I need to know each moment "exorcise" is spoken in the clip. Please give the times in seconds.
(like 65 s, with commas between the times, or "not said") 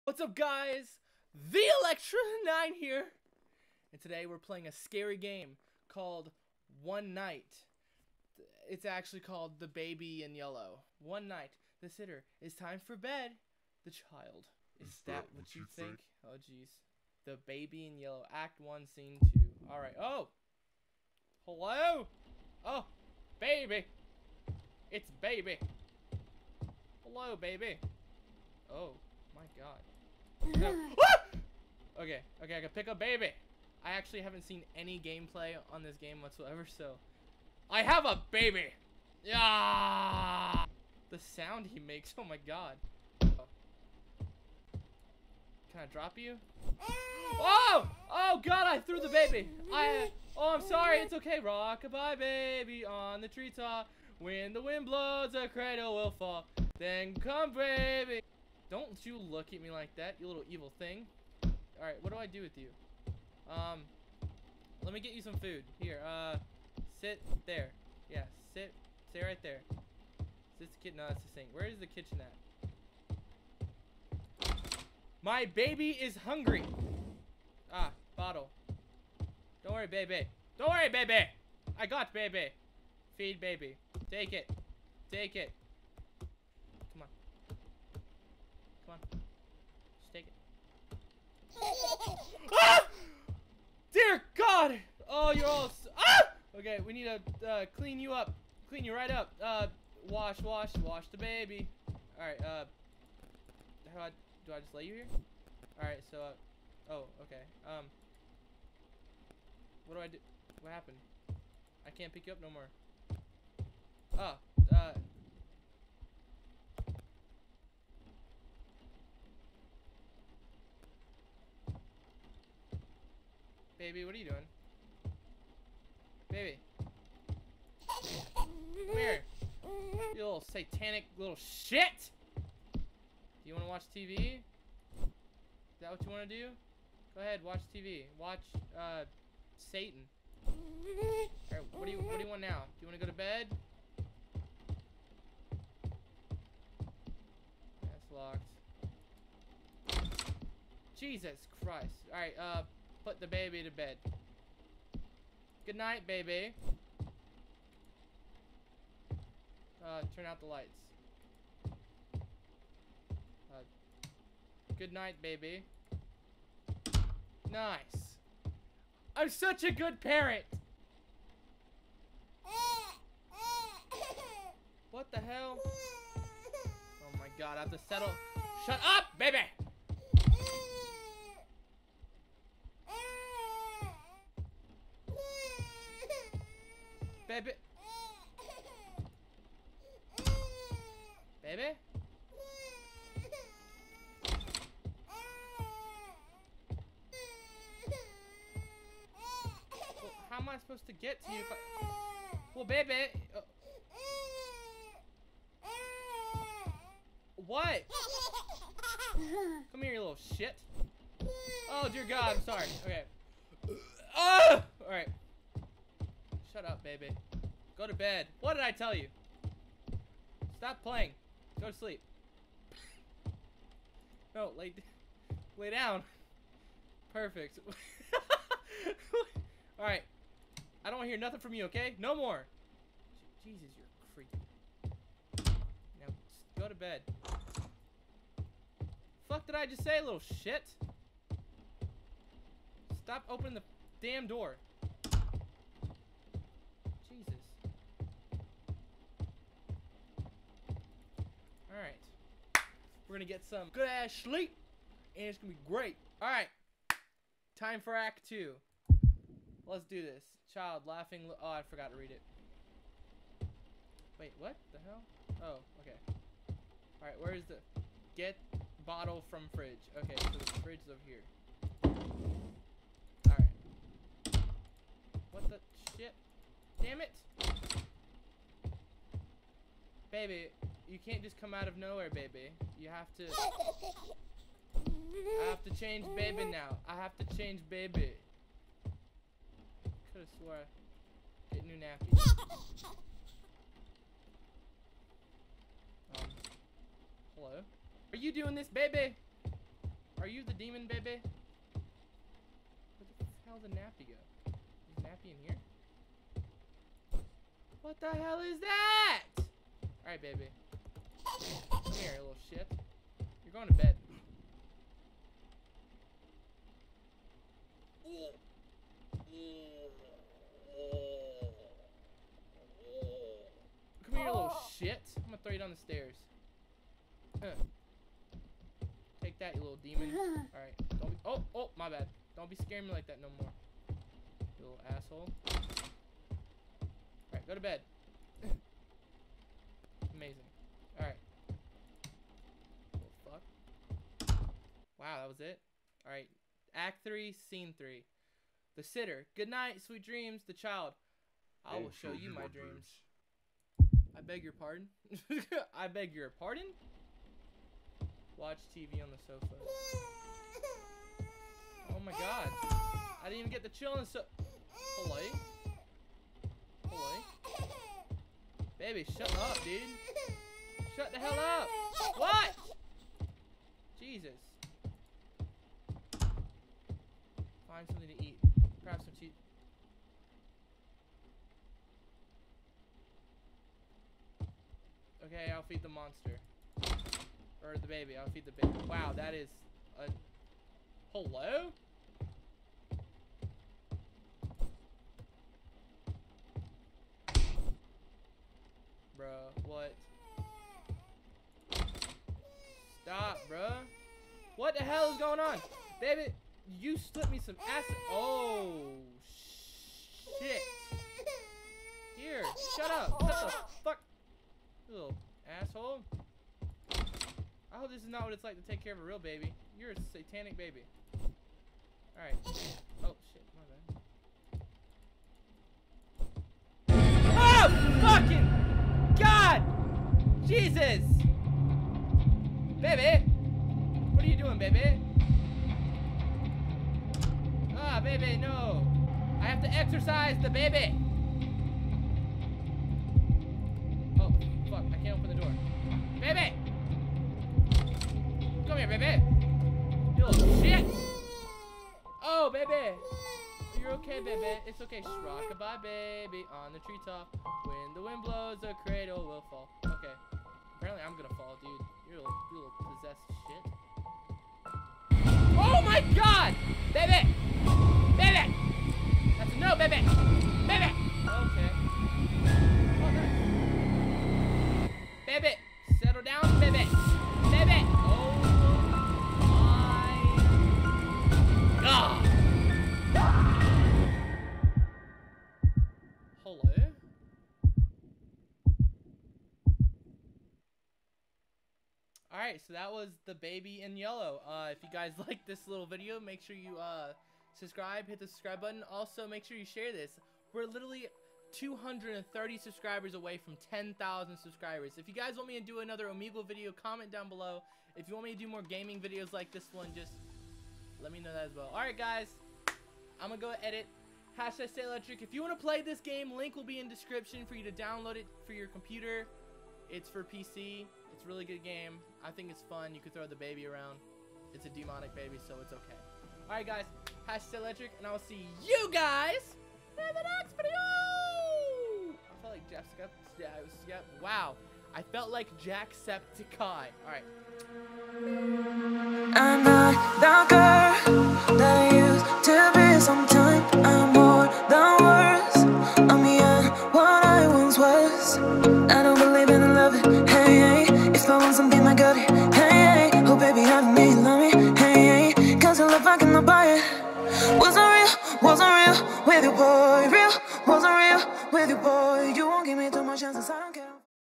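439 s.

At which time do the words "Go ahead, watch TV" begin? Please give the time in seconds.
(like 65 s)
137 s.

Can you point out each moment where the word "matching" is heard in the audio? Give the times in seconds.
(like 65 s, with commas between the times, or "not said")
not said.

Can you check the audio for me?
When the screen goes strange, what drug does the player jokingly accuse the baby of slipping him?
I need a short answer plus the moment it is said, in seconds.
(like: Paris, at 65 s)
acid, at 407 s.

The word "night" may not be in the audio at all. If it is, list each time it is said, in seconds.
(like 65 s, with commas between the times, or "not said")
7 s, 11 s, 155 s, 164 s, 349 s.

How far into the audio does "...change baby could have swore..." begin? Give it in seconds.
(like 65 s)
287 s.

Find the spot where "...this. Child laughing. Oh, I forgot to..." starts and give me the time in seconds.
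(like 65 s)
260 s.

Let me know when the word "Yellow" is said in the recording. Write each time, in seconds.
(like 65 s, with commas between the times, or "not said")
10 s, 17 s, 493 s.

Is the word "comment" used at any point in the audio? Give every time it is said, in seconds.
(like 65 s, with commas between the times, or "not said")
506 s.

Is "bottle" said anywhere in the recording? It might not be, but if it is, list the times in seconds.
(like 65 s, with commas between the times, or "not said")
78 s, 268 s.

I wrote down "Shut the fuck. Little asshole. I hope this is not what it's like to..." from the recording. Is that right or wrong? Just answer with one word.
right.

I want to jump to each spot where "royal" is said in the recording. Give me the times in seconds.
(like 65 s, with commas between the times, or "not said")
not said.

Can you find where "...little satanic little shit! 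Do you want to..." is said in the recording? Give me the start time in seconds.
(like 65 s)
130 s.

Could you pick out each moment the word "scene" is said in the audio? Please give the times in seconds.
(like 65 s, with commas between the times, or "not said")
18 s, 347 s.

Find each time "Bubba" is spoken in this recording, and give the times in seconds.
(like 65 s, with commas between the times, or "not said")
not said.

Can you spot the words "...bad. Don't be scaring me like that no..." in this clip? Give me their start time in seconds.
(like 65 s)
331 s.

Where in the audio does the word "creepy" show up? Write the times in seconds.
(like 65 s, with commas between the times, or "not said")
234 s.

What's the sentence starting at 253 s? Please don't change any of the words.
We're gonna get some good ass sleep, and it's gonna be great.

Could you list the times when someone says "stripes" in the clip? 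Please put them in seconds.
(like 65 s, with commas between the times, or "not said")
not said.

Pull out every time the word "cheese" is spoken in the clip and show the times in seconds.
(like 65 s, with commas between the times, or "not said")
379 s.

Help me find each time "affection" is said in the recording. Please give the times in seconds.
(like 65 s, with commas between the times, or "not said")
not said.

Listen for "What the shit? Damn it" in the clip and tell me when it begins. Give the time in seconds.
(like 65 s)
275 s.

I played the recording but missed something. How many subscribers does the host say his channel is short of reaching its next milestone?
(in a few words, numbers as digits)
230.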